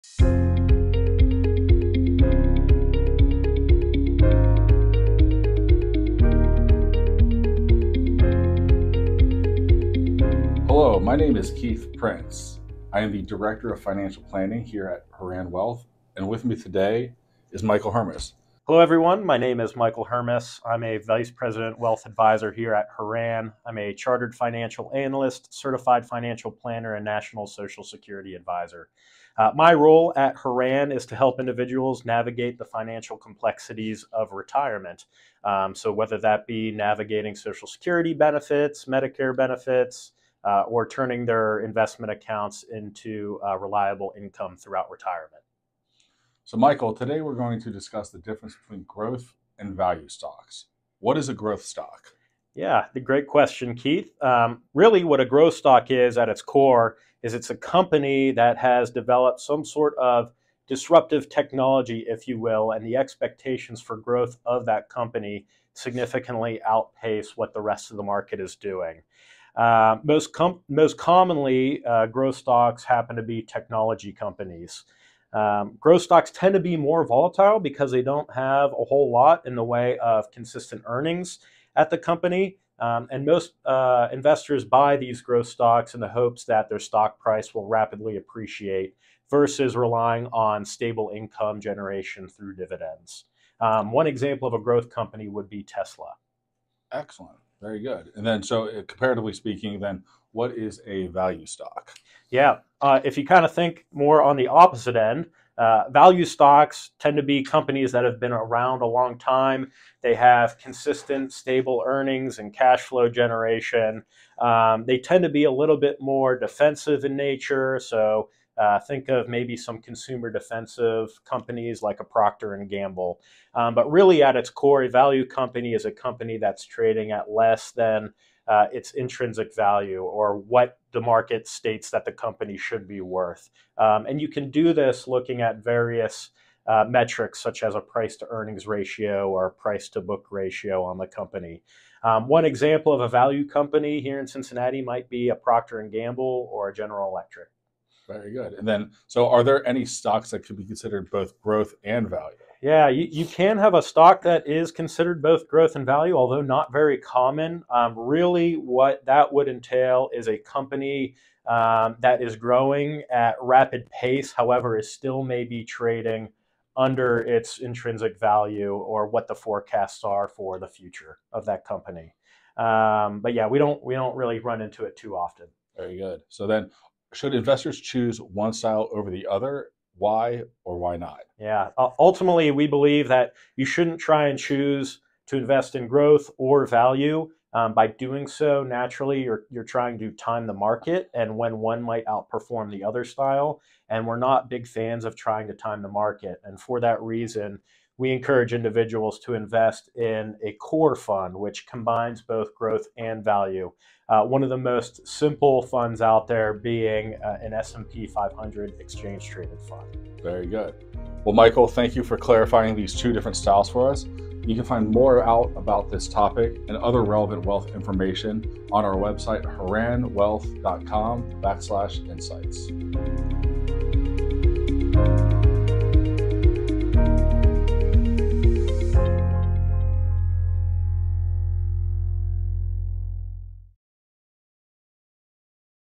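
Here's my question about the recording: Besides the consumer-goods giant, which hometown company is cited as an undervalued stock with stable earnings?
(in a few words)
General Electric.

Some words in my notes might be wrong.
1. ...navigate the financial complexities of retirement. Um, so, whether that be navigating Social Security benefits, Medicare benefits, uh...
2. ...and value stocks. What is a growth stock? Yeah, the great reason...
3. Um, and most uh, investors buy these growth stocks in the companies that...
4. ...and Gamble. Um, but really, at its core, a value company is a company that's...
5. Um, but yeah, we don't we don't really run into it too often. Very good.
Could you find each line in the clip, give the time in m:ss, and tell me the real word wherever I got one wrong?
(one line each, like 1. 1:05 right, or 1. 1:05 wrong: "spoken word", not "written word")
1. 0:32 right
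2. 0:49 wrong: "question", not "reason"
3. 1:22 wrong: "hopes", not "companies"
4. 2:02 right
5. 2:52 right.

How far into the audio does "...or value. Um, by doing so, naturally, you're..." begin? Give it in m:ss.
3:06.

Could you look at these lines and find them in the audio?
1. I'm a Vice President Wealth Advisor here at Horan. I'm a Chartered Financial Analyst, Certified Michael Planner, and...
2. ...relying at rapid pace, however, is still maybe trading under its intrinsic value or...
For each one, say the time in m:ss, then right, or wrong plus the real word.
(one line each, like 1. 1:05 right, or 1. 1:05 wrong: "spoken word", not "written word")
1. 0:20 wrong: "Financial", not "Michael"
2. 2:42 wrong: "growing", not "relying".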